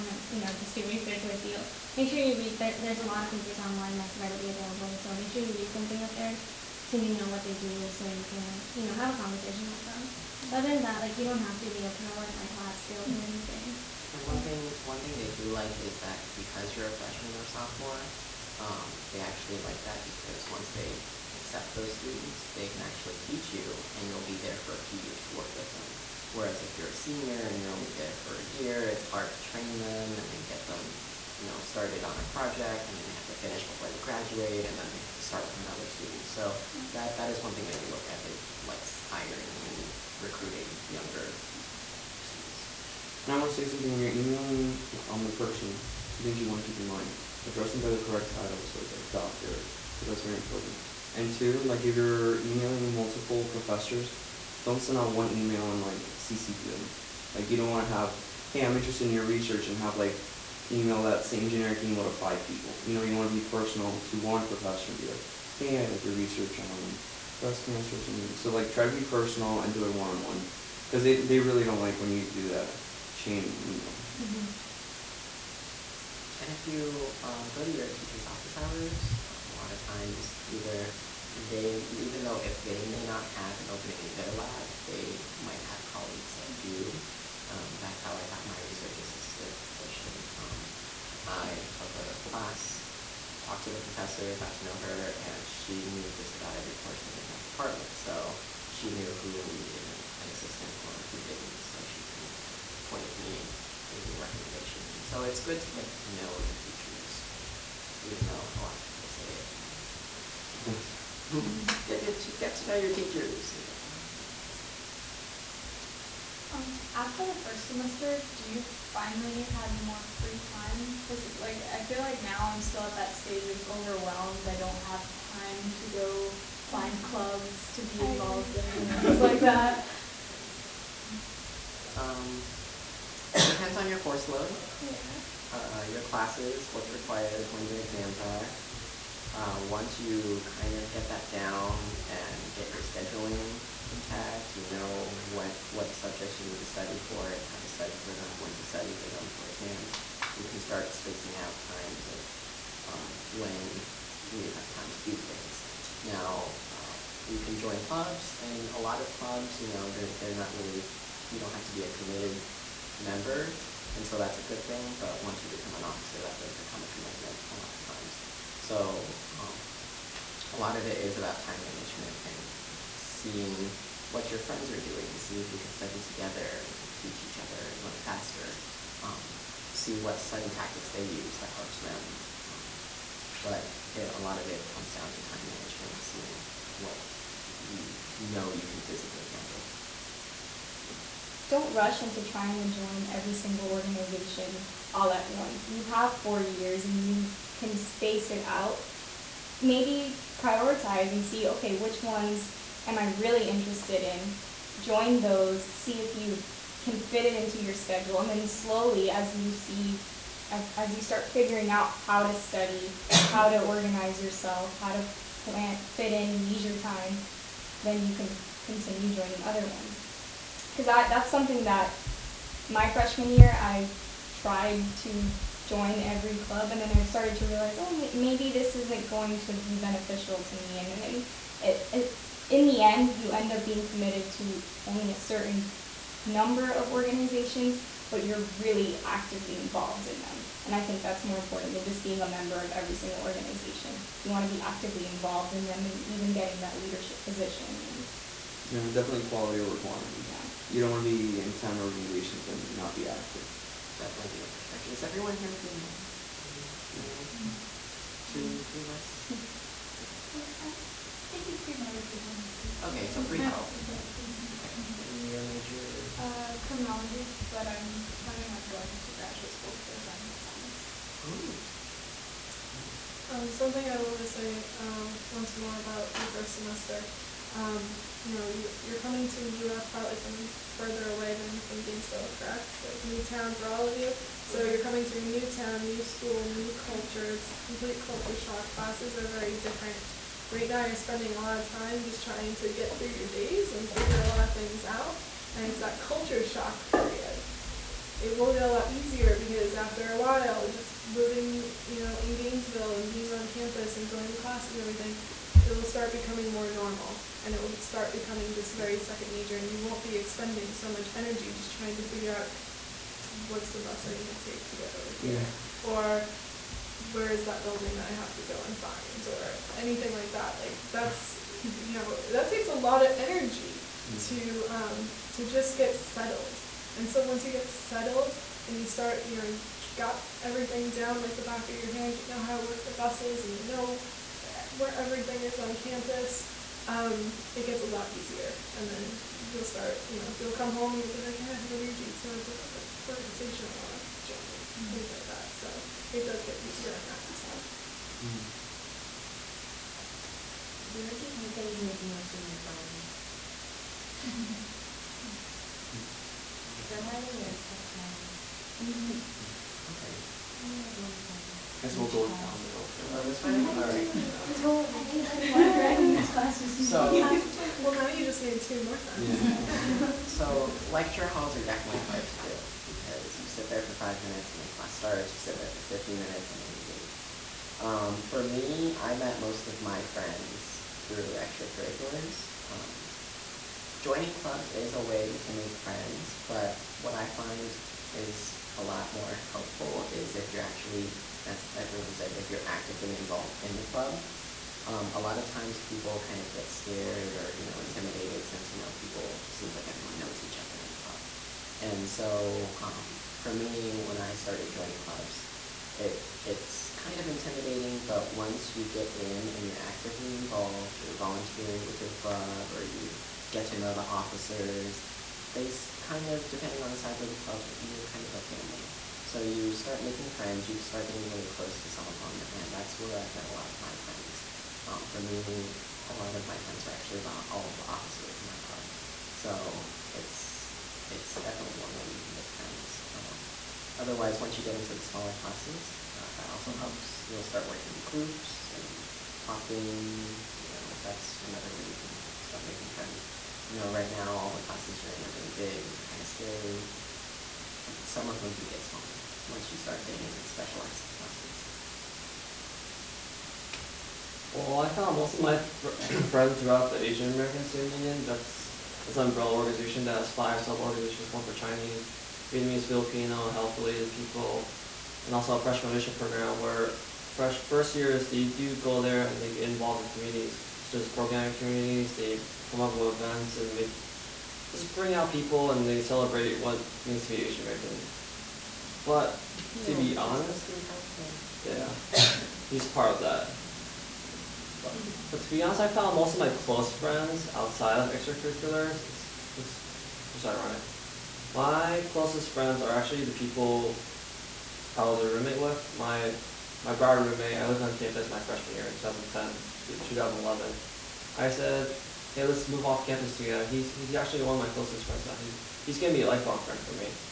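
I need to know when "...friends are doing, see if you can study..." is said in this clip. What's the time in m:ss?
2:54.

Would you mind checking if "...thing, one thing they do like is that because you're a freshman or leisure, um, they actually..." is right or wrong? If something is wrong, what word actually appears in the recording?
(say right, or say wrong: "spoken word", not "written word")
wrong: "sophomore", not "leisure".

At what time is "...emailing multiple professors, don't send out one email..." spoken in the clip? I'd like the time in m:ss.
0:52.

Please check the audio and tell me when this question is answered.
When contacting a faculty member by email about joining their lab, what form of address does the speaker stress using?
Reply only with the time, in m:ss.
0:49.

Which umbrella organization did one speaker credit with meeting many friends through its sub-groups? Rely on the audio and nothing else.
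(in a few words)
Asian American Student Union.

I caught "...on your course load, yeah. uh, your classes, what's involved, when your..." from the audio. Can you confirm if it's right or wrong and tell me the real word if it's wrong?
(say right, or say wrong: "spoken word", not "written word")
wrong: "required", not "involved".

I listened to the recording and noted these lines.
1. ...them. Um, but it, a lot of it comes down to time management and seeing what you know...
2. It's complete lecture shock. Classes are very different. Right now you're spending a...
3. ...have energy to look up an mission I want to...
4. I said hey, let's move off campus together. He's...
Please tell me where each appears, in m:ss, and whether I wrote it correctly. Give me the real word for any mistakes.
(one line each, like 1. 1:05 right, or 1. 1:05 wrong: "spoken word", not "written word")
1. 3:01 right
2. 4:47 wrong: "culture", not "lecture"
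3. 5:41 wrong: "organization", not "mission"
4. 8:21 right.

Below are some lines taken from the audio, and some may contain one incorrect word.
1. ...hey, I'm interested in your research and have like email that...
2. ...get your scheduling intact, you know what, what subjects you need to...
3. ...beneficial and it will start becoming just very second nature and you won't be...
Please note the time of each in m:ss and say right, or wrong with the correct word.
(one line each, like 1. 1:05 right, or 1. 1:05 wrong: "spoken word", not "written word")
1. 0:58 right
2. 2:22 right
3. 5:06 wrong: "normal", not "beneficial".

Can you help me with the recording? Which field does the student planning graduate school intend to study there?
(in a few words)
Forensic science.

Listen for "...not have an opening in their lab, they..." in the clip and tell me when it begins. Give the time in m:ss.
1:23.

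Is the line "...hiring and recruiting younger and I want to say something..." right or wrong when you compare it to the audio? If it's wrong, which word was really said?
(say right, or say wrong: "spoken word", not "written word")
right.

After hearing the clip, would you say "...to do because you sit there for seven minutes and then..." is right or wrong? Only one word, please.
wrong.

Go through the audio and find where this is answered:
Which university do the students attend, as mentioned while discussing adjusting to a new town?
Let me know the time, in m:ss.
4:39.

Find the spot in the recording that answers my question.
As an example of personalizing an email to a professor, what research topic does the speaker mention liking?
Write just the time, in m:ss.
1:07.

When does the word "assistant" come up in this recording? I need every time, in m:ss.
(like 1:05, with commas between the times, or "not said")
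1:29, 1:40.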